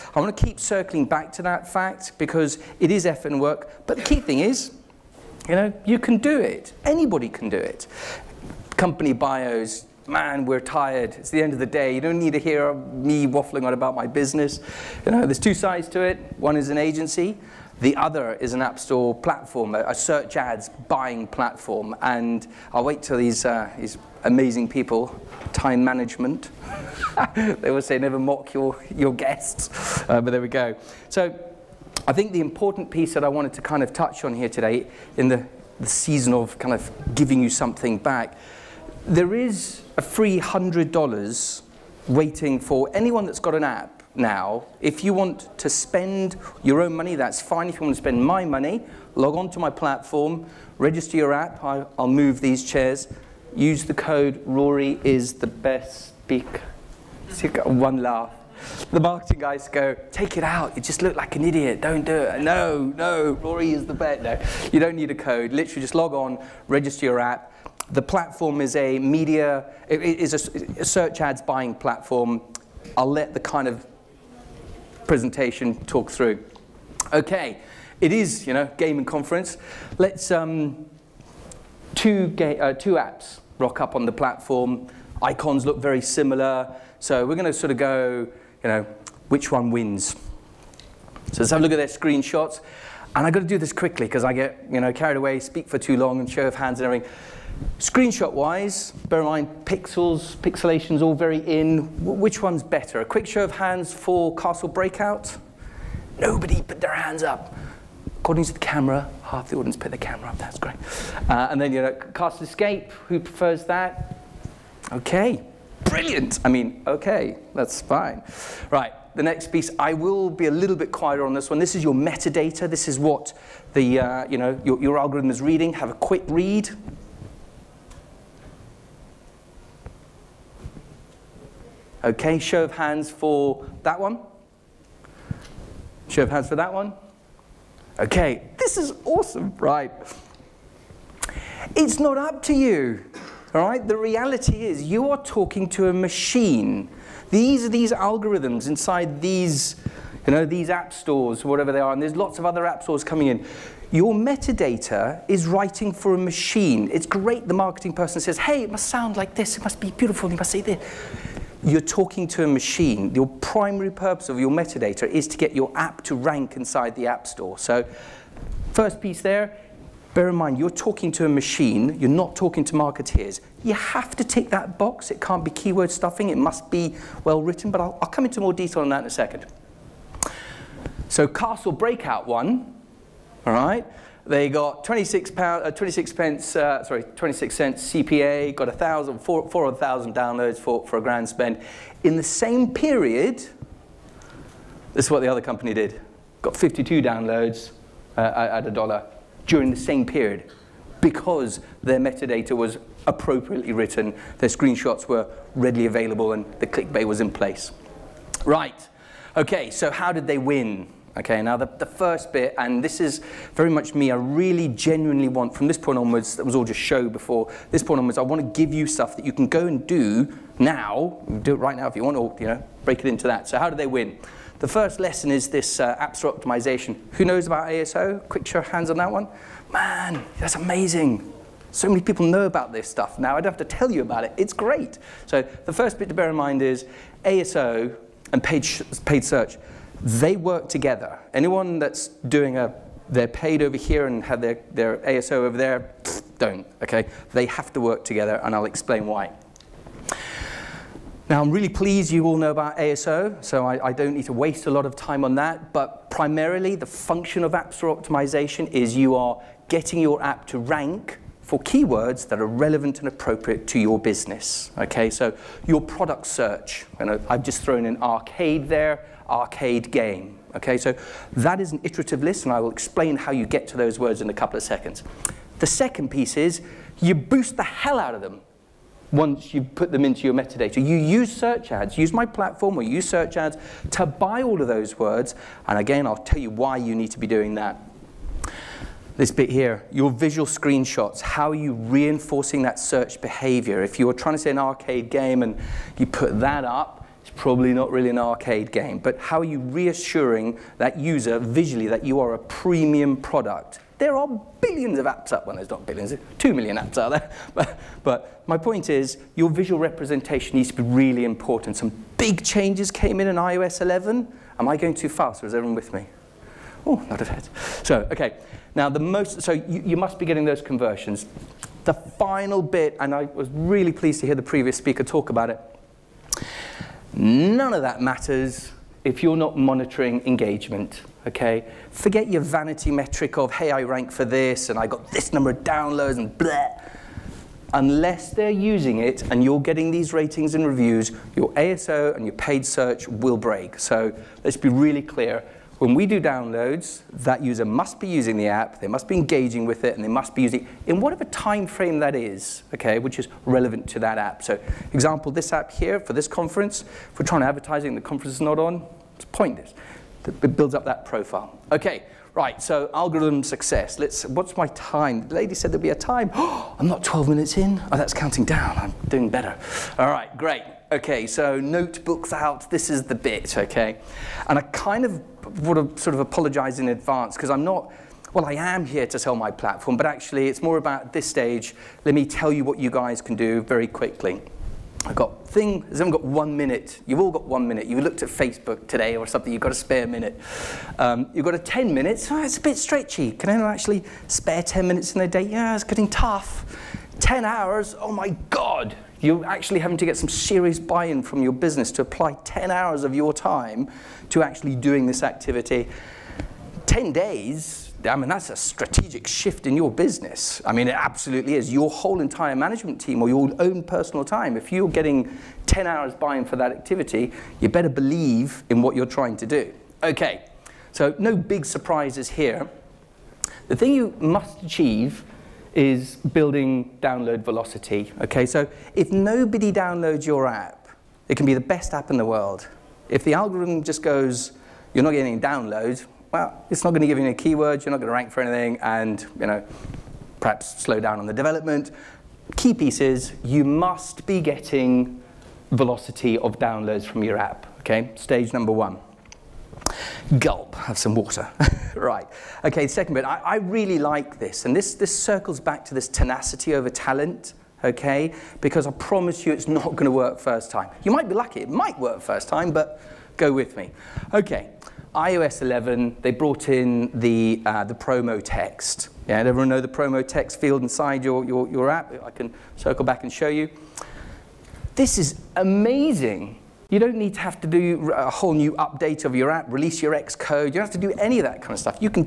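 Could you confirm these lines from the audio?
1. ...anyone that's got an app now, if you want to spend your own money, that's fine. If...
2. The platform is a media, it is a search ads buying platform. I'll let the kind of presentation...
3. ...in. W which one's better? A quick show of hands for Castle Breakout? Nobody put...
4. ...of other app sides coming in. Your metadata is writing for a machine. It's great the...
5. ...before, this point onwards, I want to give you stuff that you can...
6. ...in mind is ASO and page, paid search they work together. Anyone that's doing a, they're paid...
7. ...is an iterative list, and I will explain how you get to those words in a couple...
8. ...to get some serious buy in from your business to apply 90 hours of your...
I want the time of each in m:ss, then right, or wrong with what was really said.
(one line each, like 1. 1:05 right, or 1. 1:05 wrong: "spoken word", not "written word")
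1. 0:42 right
2. 1:07 right
3. 1:41 right
4. 2:32 wrong: "stores", not "sides"
5. 3:37 right
6. 3:56 right
7. 4:31 right
8. 6:39 wrong: "10", not "90".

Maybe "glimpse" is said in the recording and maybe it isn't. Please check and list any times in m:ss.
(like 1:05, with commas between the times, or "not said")
not said.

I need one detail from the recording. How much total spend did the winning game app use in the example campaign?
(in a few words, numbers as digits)
a grand.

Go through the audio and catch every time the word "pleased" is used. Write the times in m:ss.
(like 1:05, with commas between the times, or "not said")
4:11, 5:23.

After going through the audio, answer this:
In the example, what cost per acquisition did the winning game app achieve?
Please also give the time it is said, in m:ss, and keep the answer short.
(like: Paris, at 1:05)
26 cents, at 3:07.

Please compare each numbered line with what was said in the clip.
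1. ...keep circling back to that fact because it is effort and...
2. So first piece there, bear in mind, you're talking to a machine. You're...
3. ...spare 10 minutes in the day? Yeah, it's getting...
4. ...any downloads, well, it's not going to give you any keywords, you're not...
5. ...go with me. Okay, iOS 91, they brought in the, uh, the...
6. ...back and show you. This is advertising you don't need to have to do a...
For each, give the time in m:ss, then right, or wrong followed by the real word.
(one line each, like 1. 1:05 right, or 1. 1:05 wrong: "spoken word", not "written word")
1. 0:00 right
2. 2:47 right
3. 6:34 right
4. 7:15 right
5. 7:43 wrong: "11", not "91"
6. 7:53 wrong: "amazing", not "advertising".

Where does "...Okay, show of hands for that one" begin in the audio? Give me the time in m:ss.
2:12.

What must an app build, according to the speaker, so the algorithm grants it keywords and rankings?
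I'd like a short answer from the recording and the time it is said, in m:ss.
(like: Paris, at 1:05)
download velocity, at 7:07.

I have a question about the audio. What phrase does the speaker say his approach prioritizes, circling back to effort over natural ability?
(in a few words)
tenacity over talent.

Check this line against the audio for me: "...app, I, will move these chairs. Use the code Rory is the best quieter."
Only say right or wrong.
wrong.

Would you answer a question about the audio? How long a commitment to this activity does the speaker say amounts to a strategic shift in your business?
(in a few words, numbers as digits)
10 days.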